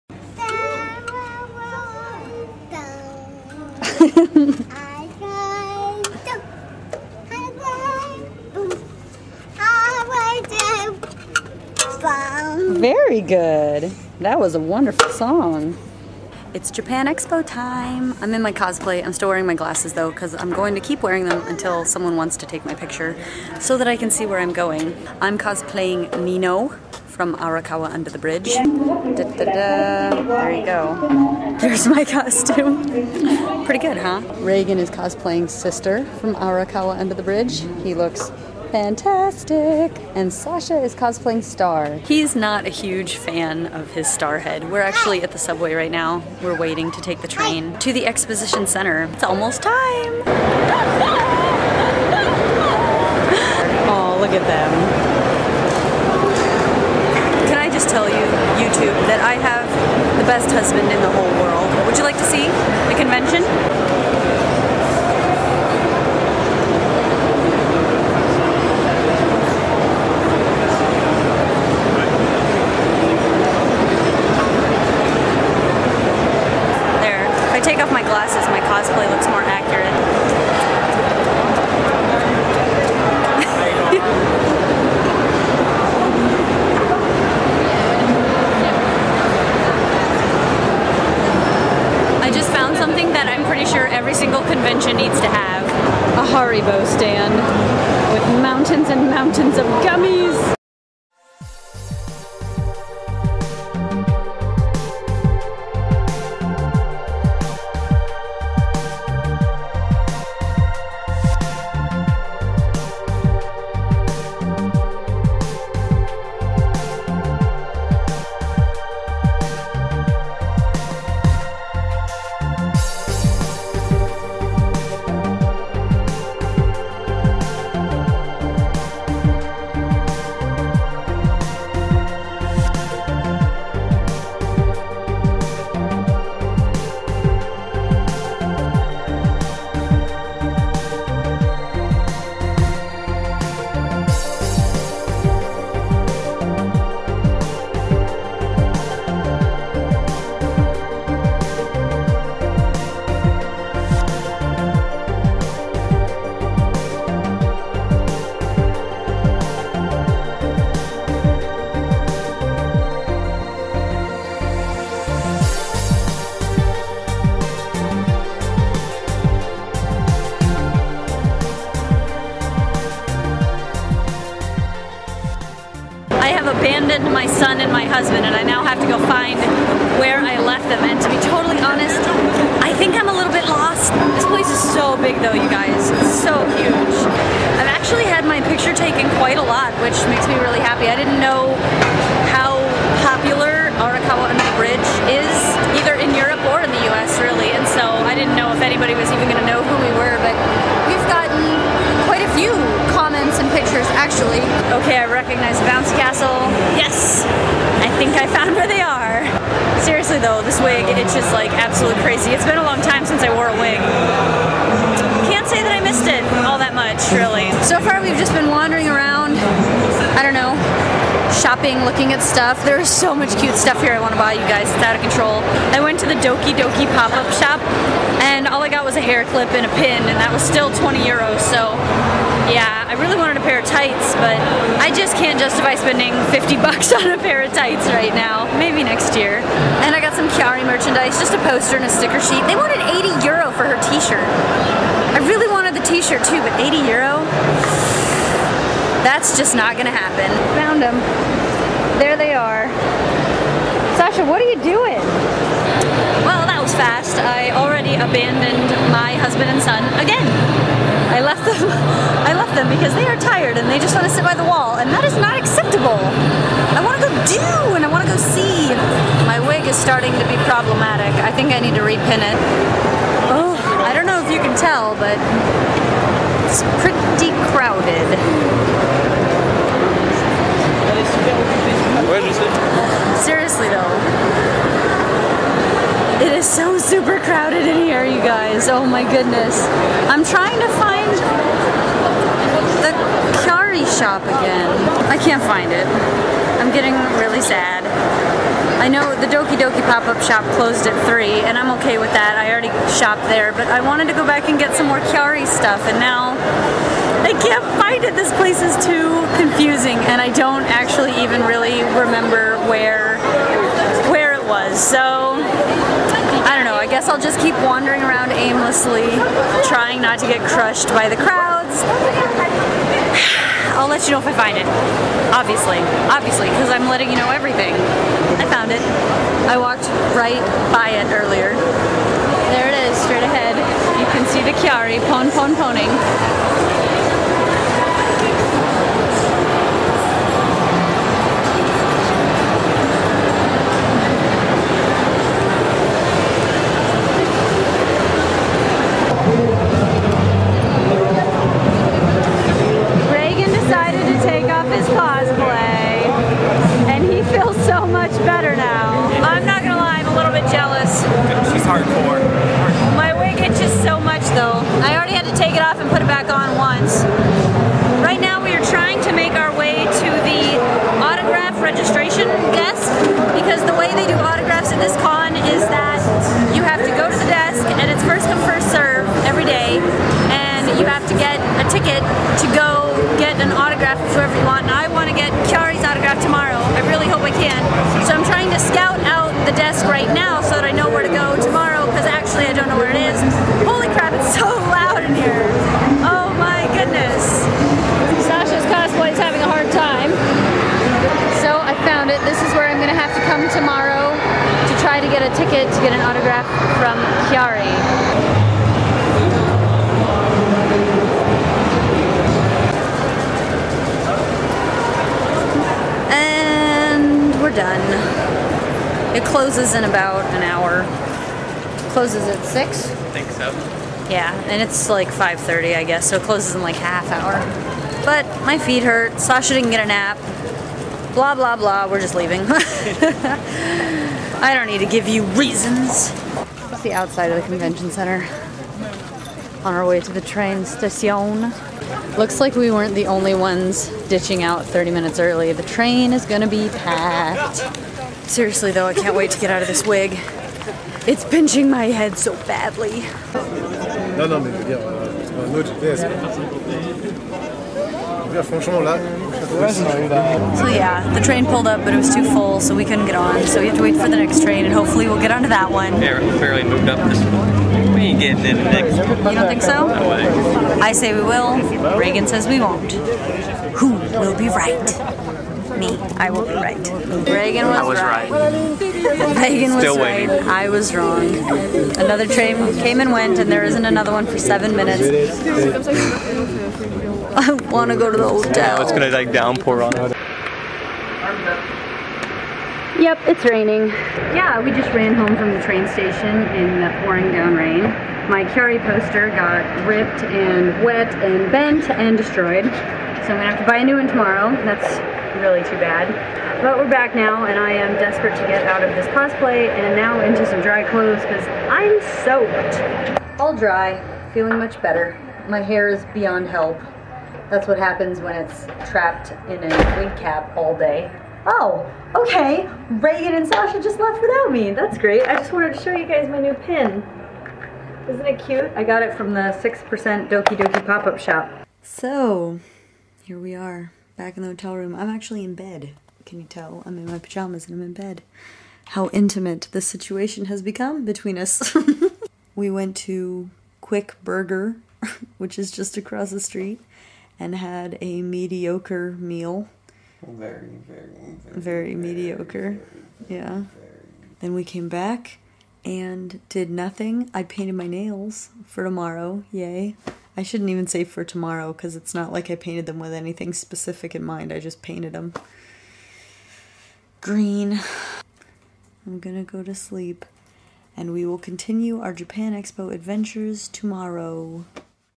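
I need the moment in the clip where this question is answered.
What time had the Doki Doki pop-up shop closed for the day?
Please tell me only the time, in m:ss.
5:00.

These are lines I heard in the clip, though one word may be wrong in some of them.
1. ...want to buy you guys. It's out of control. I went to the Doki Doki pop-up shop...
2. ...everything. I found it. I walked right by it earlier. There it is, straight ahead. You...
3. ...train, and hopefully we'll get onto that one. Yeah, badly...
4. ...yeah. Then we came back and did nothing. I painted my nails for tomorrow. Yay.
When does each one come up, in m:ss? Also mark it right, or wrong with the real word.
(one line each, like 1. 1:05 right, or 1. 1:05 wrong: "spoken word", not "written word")
1. 3:43 right
2. 5:27 right
3. 7:44 wrong: "barely", not "badly"
4. 9:13 right.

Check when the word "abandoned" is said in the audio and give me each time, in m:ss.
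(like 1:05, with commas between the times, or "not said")
4:17.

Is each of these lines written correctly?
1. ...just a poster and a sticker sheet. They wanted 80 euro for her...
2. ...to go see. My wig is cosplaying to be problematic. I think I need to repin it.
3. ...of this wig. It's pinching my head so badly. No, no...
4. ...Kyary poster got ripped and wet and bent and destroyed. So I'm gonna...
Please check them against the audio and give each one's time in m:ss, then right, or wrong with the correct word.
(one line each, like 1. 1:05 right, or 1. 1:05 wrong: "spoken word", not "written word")
1. 4:01 right
2. 4:28 wrong: "starting", not "cosplaying"
3. 7:29 right
4. 8:18 right.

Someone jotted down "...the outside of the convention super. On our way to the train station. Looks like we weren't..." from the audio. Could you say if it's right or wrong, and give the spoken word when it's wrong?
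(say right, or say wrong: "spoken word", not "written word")
wrong: "center", not "super".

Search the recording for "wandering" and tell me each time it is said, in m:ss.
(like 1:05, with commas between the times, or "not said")
3:38, 5:17.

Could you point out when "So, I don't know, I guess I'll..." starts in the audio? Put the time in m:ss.
5:14.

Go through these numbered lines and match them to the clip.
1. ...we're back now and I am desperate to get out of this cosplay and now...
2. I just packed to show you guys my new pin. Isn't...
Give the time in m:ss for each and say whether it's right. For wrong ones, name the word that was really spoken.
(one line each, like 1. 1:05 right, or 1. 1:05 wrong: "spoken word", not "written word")
1. 8:26 right
2. 8:45 wrong: "wanted", not "packed".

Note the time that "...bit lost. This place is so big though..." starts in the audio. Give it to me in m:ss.
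3:03.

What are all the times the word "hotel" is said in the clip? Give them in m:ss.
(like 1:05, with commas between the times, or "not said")
8:08, 8:54.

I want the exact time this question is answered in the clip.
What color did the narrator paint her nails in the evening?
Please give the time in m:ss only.
9:27.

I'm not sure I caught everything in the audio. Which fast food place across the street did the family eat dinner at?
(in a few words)
Quick Burger.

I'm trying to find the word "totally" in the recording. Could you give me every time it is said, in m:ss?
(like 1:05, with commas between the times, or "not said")
3:01.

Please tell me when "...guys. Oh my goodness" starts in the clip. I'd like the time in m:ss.
4:48.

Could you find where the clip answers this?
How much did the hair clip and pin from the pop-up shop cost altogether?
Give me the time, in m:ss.
3:50.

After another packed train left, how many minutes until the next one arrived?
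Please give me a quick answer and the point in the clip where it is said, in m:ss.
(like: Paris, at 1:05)
7, at 8:04.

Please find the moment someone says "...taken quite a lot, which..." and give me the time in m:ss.
3:08.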